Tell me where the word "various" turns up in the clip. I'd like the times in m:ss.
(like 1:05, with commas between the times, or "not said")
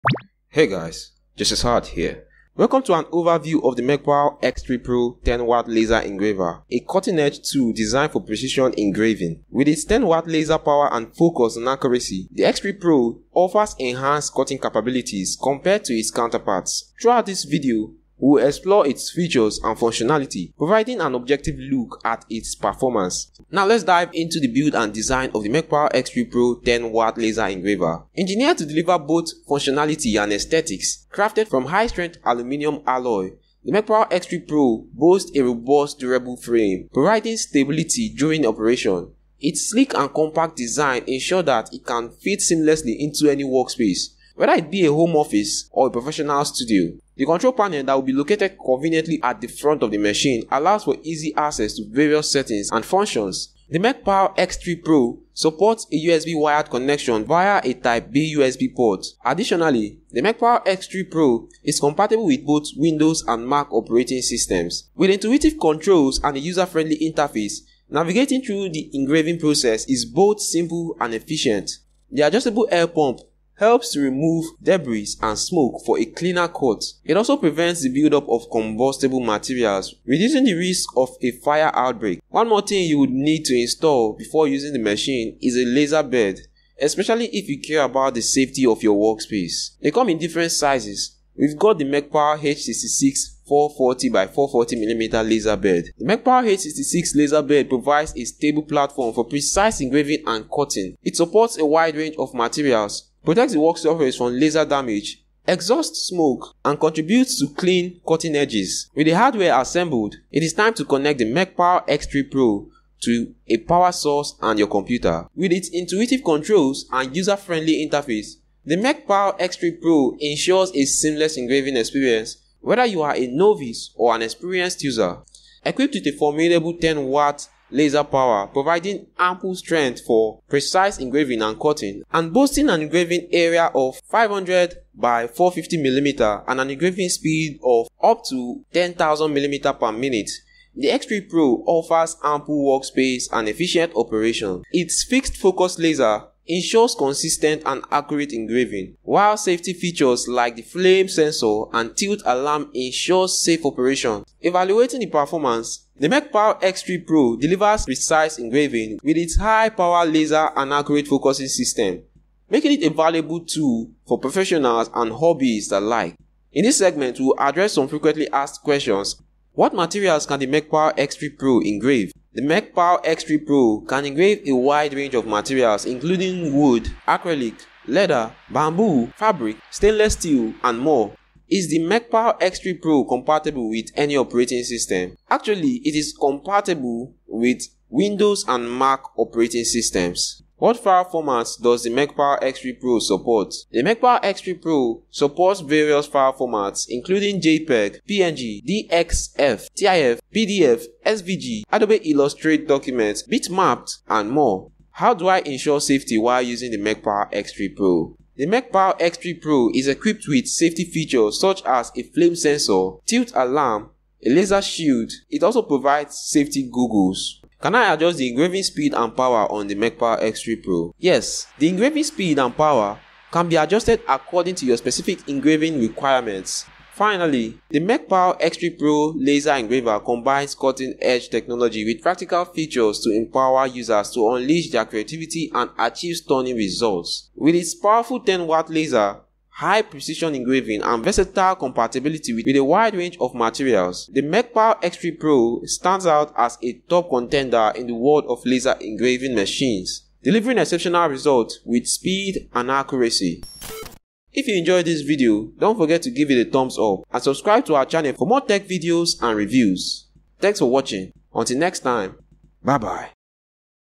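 0:51, 3:15.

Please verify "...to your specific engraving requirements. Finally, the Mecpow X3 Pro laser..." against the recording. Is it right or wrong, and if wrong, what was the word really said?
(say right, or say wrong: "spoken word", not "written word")
right.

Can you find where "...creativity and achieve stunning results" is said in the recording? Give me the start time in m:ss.
3:54.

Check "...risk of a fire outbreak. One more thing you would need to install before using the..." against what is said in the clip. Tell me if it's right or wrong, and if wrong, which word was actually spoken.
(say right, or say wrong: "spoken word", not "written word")
right.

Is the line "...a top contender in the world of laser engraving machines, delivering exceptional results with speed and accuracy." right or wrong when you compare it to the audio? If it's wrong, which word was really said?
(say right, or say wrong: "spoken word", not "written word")
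right.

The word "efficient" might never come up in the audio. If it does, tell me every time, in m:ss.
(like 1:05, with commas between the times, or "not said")
1:11, 2:23.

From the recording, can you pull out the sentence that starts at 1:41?
It supports a wide range of materials, protects the work surface from laser damage, exhausts smoke, and contributes to clean cutting edges.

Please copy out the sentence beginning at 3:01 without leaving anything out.
Is the Mecpow X3 Pro compatible with any operating system?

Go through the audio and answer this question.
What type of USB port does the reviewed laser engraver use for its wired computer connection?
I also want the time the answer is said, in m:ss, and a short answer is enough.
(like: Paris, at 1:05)
Type B, at 0:57.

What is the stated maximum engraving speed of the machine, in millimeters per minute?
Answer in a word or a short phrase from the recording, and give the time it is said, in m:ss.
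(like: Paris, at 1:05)
10,000 mm per minute, at 2:18.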